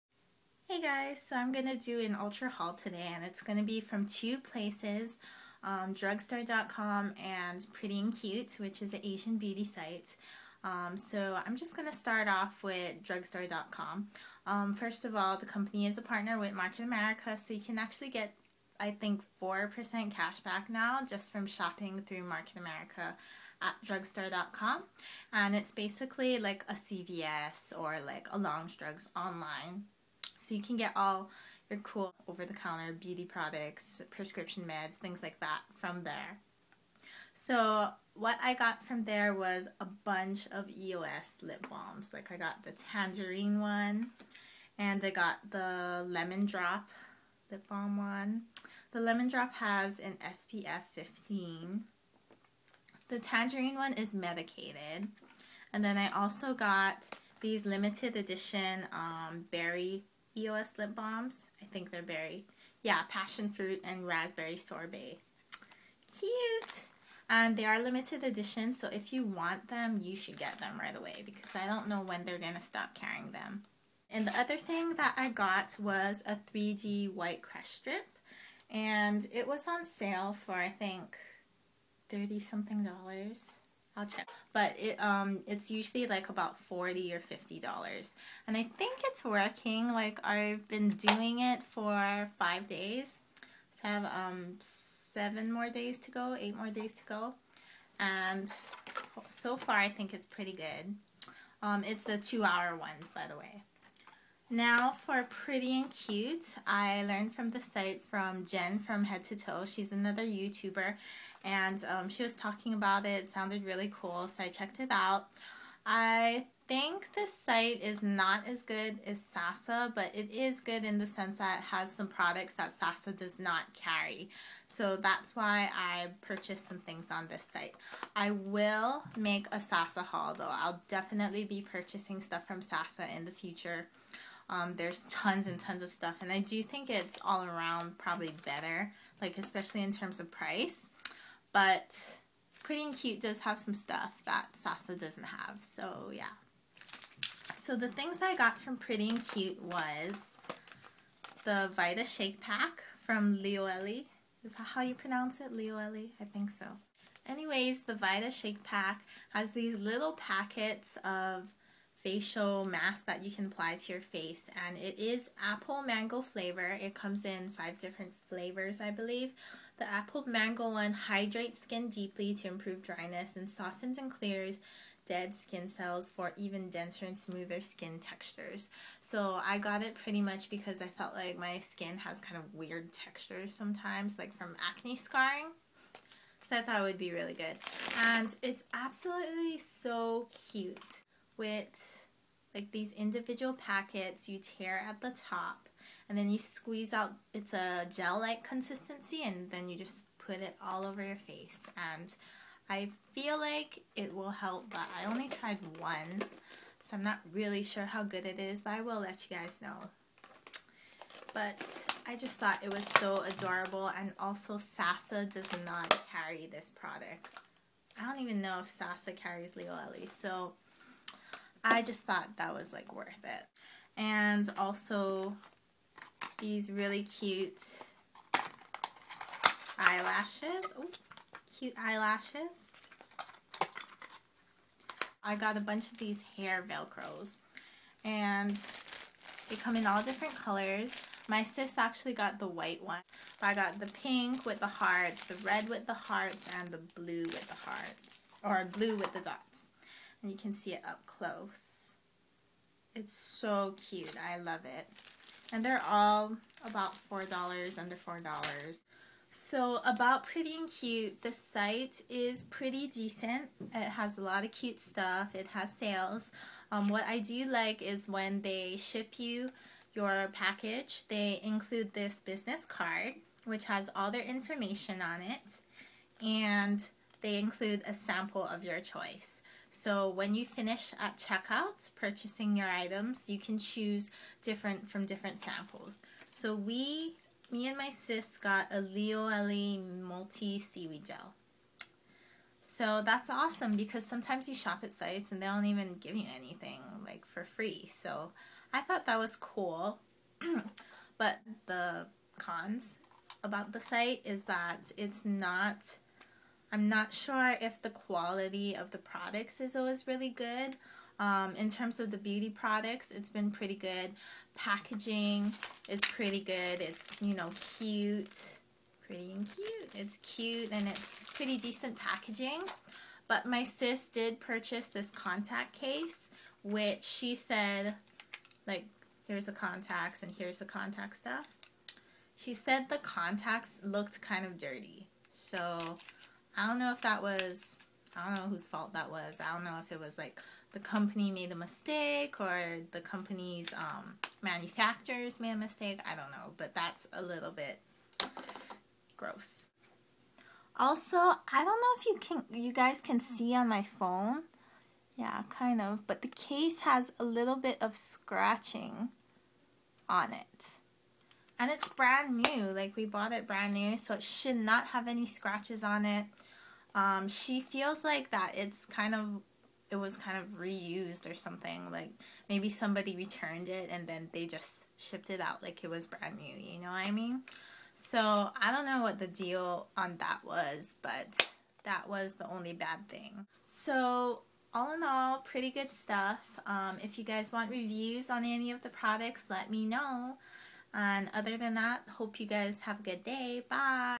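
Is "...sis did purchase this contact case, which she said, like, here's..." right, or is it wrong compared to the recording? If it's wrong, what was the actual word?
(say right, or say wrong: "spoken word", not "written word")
right.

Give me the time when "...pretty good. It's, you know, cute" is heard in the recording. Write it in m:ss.
5:15.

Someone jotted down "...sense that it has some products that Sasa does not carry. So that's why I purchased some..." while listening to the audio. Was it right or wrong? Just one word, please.
right.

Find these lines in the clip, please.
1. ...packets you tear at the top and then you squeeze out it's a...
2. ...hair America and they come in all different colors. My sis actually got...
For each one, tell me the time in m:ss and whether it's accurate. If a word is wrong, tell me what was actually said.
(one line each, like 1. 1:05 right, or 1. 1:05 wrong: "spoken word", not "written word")
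1. 3:13 right
2. 3:56 wrong: "Velcros", not "America".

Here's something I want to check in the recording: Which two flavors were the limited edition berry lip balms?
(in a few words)
Passion fruit and raspberry sorbet.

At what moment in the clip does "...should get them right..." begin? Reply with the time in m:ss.
1:10.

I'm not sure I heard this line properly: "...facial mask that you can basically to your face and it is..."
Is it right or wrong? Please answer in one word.
wrong.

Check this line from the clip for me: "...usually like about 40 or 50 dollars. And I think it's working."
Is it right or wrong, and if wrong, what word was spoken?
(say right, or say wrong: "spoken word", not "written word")
right.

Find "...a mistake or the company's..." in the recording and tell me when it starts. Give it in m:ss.
5:41.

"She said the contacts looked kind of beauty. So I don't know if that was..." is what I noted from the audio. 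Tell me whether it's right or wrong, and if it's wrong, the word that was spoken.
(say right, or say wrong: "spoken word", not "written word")
wrong: "dirty", not "beauty".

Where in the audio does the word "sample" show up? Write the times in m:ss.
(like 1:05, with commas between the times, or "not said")
4:37, 4:45.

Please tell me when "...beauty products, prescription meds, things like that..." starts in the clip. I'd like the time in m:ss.
0:32.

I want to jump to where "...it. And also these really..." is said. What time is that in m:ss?
3:43.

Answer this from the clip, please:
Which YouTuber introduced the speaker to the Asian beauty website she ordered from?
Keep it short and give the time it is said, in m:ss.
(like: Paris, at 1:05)
Jen from Head to Toe, at 1:48.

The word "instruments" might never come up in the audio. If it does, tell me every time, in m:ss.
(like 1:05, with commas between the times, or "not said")
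not said.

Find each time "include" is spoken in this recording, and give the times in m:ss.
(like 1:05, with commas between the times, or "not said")
4:31, 4:37.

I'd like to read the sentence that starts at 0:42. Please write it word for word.
Like I got the tangerine one and I got the lemon drop lip balm one.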